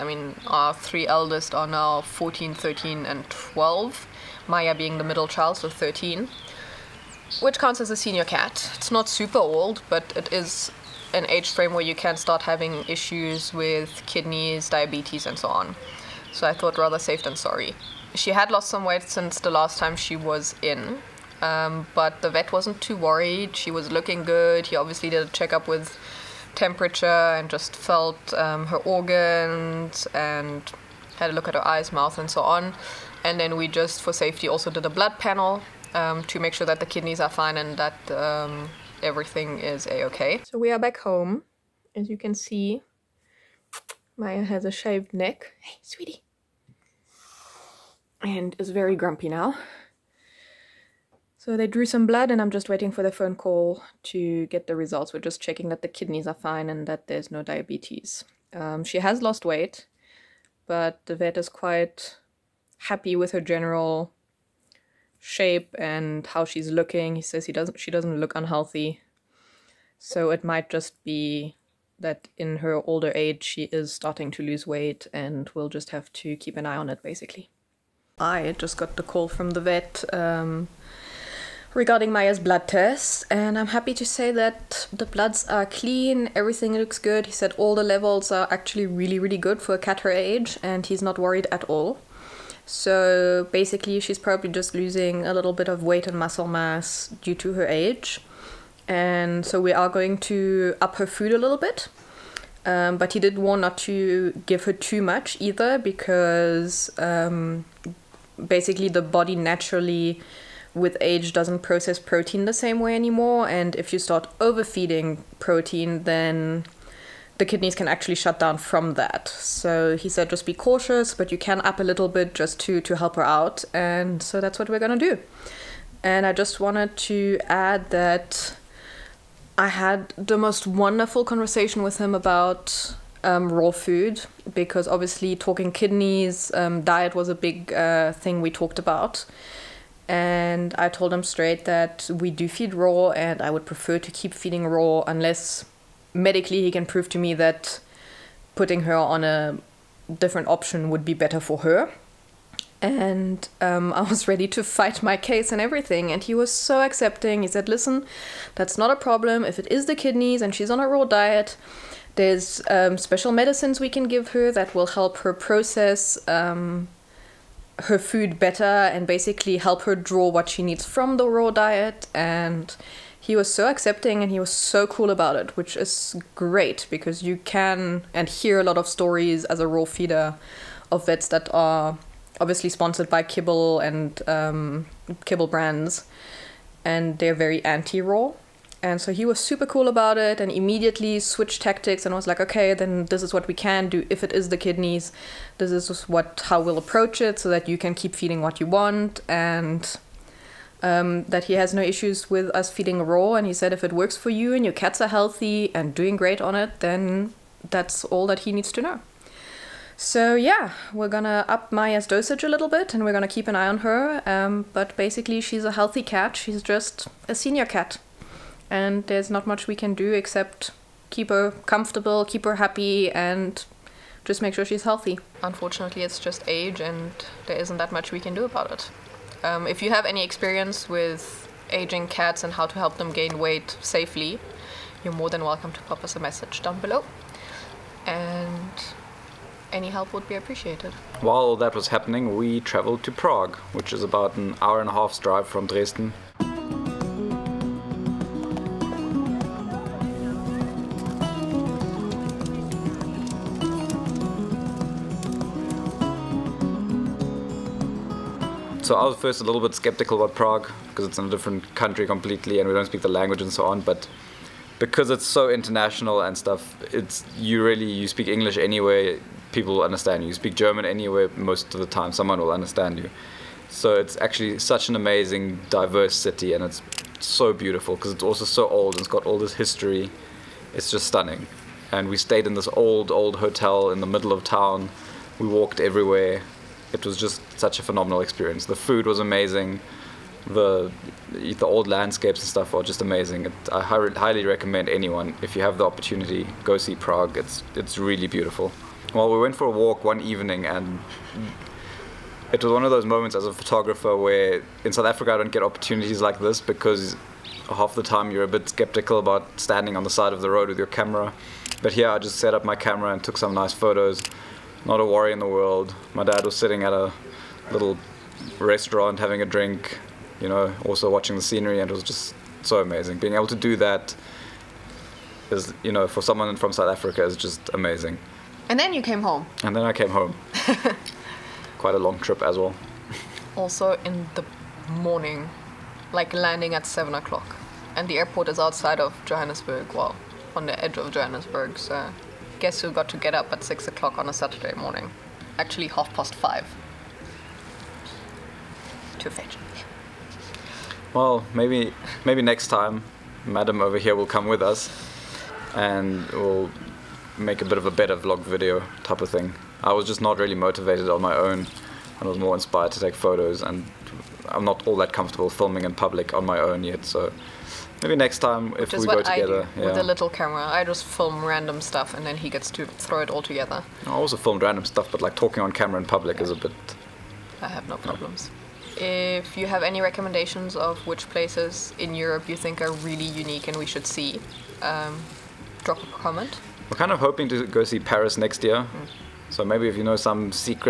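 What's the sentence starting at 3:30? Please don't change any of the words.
So yeah, we're gonna up Maya's dosage a little bit and we're gonna keep an eye on her.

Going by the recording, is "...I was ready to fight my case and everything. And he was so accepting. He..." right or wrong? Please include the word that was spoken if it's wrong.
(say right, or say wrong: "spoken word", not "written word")
right.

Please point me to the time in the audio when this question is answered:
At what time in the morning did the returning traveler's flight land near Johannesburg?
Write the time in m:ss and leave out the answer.
5:36.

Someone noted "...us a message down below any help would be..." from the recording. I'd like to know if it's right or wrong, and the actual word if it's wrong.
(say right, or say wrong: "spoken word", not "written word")
right.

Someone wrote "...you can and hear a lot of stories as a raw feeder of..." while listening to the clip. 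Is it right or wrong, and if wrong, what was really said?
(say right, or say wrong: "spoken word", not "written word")
right.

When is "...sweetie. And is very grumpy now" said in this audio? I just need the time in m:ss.
0:45.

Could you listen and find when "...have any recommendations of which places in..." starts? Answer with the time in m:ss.
6:19.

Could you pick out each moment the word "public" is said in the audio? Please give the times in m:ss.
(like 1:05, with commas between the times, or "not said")
6:05, 6:16.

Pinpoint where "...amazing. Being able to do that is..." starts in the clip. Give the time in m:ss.
5:22.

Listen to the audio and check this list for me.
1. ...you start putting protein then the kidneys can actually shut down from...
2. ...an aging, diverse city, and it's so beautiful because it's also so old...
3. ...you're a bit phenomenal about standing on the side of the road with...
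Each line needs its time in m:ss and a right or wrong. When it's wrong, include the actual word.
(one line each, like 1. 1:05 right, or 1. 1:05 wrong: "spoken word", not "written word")
1. 1:53 wrong: "overfeeding", not "putting"
2. 4:34 wrong: "amazing", not "aging"
3. 5:08 wrong: "skeptical", not "phenomenal".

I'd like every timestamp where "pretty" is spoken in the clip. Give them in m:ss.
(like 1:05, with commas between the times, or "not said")
not said.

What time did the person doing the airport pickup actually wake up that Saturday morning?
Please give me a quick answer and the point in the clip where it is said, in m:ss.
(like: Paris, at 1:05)
Half past 5, at 5:45.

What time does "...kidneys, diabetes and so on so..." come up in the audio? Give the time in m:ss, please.
0:14.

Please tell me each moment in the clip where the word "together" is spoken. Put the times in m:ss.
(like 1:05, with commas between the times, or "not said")
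6:09, 6:13.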